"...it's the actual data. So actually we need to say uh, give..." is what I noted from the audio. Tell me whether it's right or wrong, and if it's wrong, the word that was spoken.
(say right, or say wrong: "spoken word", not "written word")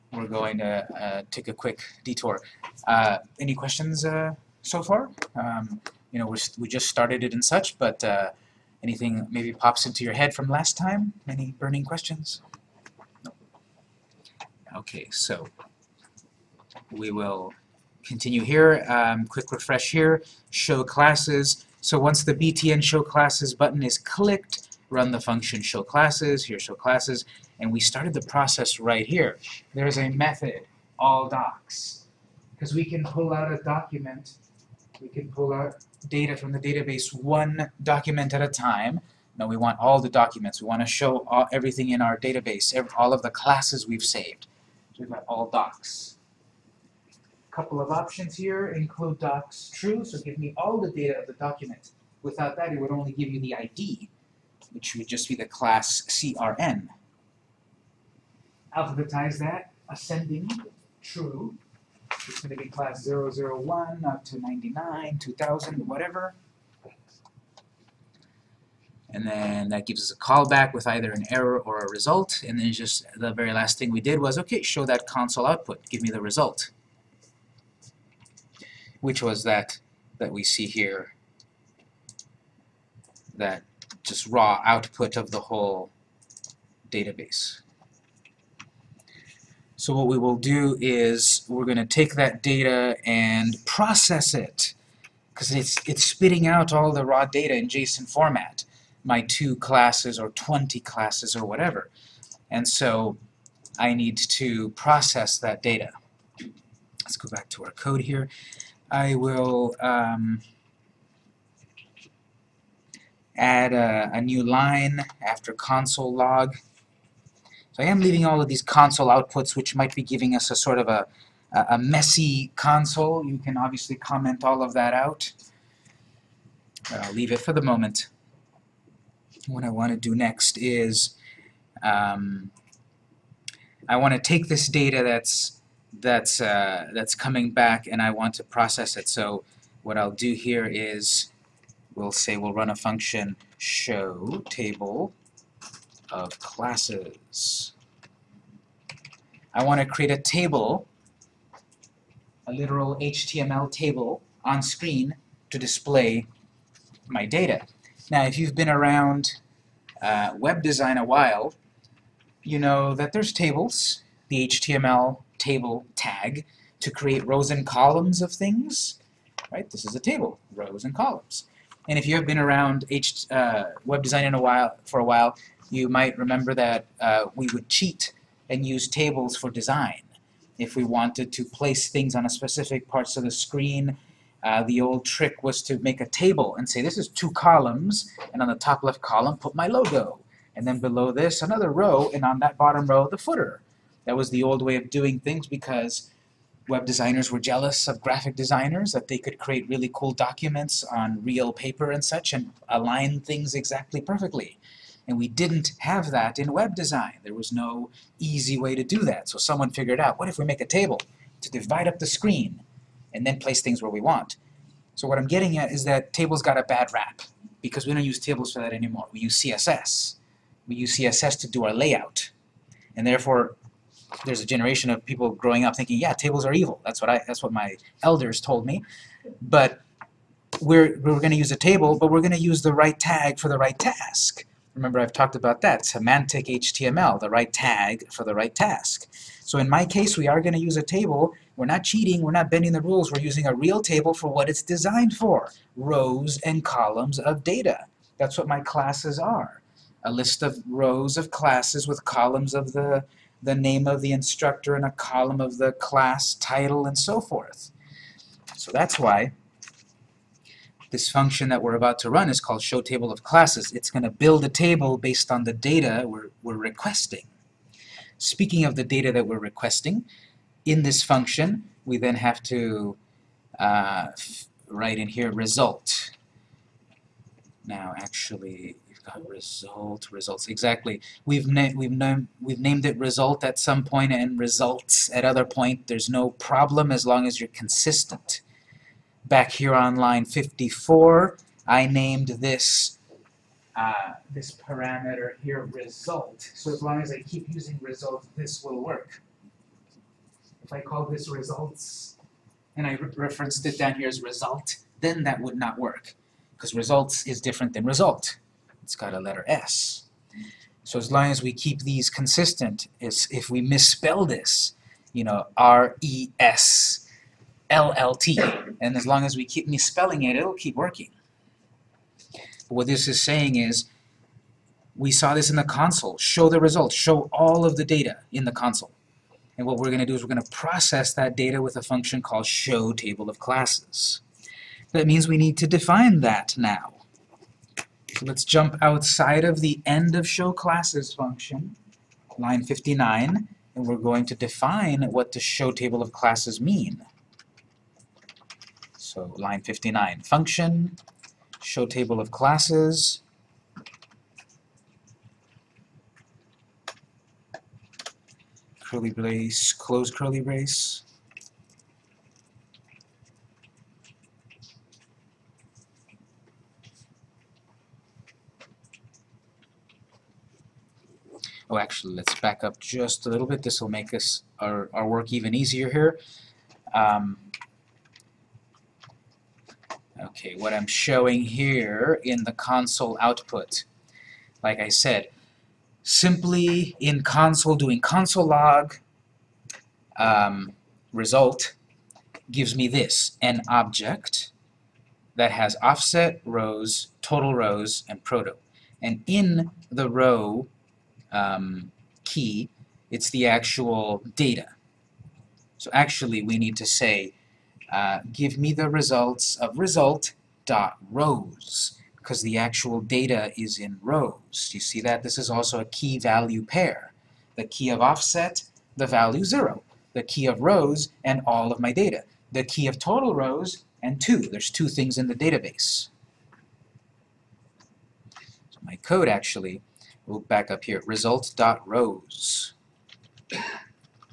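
right.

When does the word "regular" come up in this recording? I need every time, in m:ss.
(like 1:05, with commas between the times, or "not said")
not said.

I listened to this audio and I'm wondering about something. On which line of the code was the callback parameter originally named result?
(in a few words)
54.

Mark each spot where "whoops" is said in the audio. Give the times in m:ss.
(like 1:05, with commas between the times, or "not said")
not said.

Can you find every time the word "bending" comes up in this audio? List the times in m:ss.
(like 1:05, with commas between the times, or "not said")
4:02.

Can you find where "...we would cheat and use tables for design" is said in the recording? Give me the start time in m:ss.
2:57.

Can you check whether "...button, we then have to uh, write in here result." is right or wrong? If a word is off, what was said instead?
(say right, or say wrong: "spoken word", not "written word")
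wrong: "function", not "button".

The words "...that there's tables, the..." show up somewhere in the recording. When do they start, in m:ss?
2:42.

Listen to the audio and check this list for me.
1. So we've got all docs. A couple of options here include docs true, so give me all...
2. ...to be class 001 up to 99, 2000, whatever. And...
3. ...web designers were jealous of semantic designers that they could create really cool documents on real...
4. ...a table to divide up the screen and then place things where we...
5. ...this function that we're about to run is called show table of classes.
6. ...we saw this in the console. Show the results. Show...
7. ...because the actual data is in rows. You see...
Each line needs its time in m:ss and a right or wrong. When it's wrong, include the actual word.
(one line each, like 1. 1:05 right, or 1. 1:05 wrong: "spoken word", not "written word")
1. 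0:44 right
2. 1:02 right
3. 3:16 wrong: "graphic", not "semantic"
4. 3:30 right
5. 4:20 right
6. 5:24 right
7. 6:52 right.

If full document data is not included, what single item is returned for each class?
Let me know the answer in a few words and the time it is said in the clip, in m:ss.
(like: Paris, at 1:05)
the class CRN, at 0:55.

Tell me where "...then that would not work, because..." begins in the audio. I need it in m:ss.
5:05.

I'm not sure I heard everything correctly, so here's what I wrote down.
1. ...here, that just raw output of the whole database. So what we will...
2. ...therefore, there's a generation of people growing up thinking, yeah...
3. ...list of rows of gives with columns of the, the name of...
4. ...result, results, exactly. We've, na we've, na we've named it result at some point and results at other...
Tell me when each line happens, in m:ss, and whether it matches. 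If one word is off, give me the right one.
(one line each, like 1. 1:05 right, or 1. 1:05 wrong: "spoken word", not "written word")
1. 1:20 right
2. 3:43 right
3. 4:10 wrong: "classes", not "gives"
4. 4:39 right.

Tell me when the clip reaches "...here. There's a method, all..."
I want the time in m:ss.
0:29.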